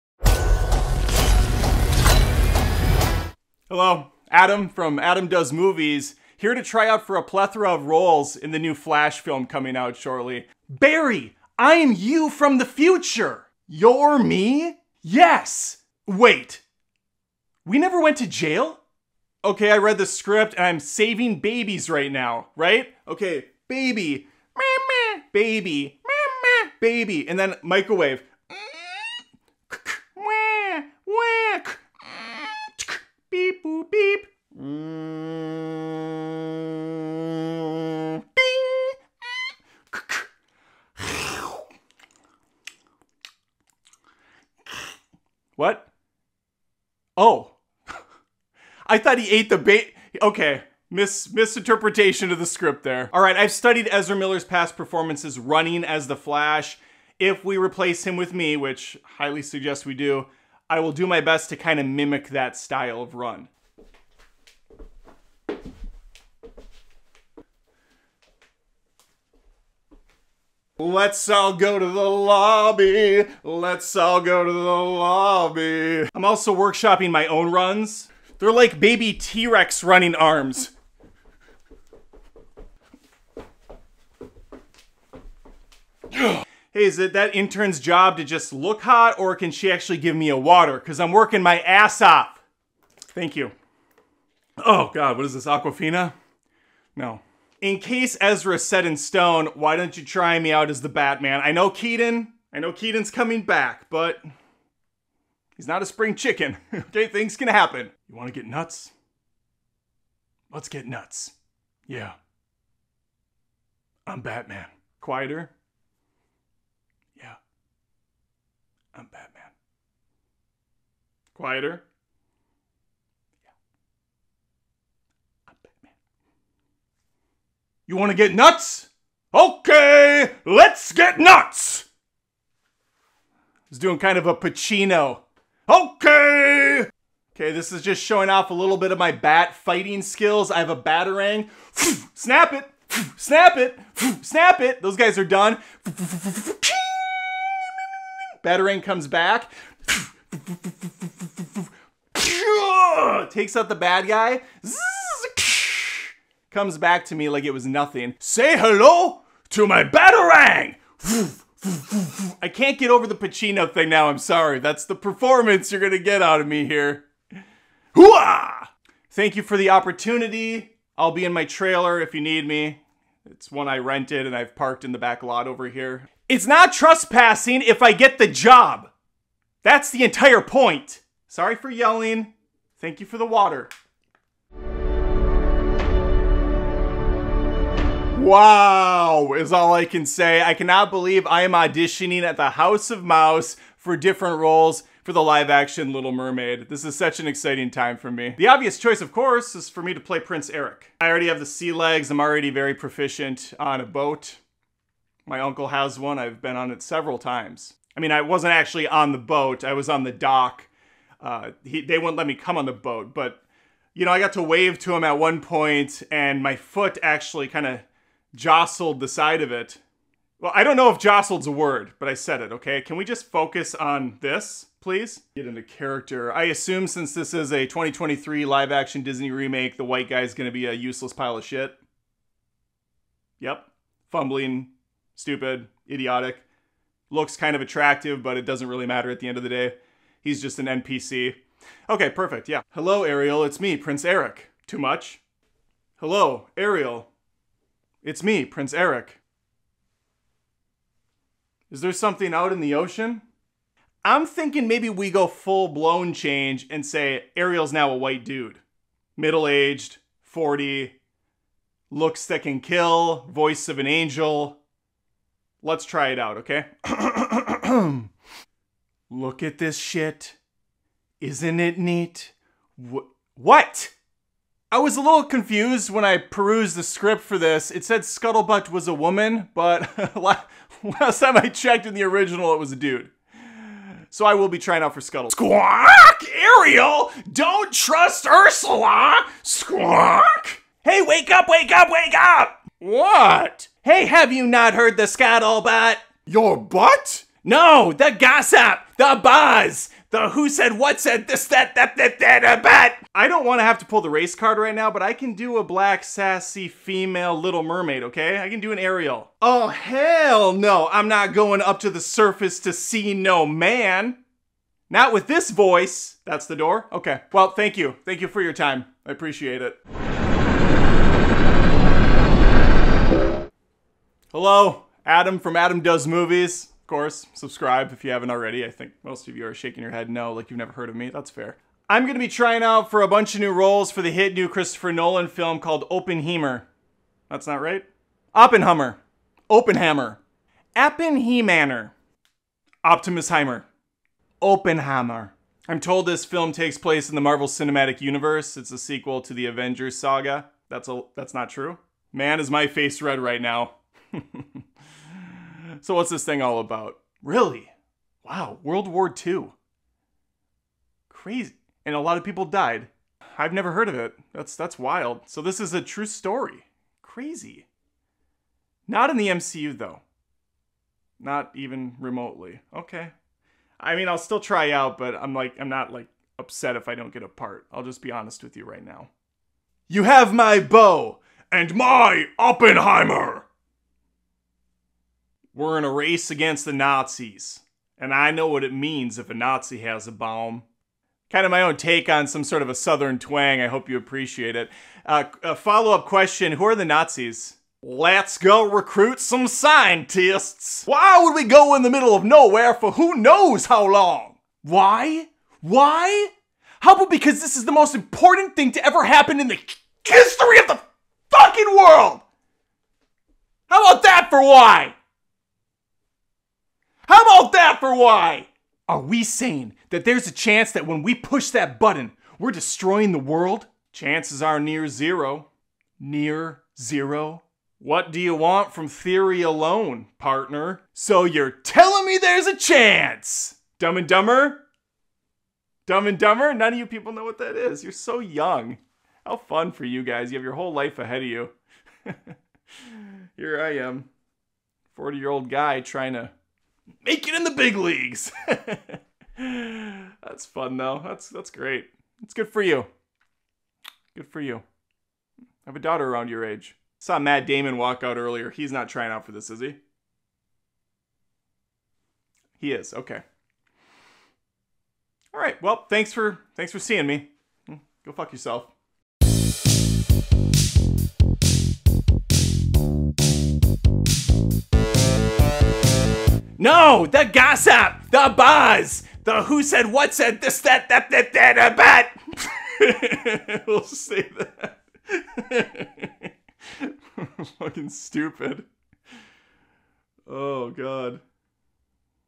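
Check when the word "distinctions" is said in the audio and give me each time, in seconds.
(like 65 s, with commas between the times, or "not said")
not said.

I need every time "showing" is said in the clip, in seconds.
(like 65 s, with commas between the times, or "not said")
138 s.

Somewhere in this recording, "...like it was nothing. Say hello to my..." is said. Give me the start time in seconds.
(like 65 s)
157 s.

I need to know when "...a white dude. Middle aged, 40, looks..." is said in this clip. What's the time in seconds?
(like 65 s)
257 s.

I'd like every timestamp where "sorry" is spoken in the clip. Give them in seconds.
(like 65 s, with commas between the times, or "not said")
164 s, 181 s.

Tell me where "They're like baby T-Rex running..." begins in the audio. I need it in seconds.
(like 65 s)
78 s.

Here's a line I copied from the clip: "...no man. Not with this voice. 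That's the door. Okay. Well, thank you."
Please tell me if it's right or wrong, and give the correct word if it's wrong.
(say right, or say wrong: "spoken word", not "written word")
right.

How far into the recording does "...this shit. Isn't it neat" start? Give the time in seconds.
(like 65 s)
269 s.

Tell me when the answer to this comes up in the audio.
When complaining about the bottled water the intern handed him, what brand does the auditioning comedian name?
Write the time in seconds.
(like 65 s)
95 s.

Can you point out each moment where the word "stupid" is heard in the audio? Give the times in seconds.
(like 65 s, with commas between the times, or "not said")
235 s, 487 s.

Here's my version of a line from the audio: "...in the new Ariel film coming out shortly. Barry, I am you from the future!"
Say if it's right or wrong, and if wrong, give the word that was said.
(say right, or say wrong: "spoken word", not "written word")
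wrong: "Flash", not "Ariel".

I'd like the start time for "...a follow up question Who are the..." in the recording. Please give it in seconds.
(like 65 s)
395 s.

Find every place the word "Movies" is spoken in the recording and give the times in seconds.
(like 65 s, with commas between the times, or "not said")
5 s, 326 s.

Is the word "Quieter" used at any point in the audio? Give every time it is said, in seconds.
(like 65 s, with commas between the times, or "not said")
114 s, 121 s.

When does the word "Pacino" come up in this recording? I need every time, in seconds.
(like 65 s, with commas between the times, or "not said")
134 s, 163 s.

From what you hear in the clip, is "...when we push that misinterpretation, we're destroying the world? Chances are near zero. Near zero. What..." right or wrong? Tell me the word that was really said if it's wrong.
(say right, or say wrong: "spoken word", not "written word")
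wrong: "button", not "misinterpretation".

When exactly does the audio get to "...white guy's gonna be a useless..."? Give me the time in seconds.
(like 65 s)
229 s.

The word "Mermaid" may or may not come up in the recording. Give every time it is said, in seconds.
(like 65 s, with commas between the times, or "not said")
196 s, 307 s.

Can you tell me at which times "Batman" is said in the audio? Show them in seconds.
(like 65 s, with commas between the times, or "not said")
100 s, 114 s, 119 s, 125 s.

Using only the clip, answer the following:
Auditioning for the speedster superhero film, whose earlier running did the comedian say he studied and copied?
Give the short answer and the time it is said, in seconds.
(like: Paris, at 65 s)
Ezra Miller, at 53 s.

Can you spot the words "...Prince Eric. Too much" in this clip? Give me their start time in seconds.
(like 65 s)
243 s.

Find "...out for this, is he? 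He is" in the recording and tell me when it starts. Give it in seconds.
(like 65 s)
459 s.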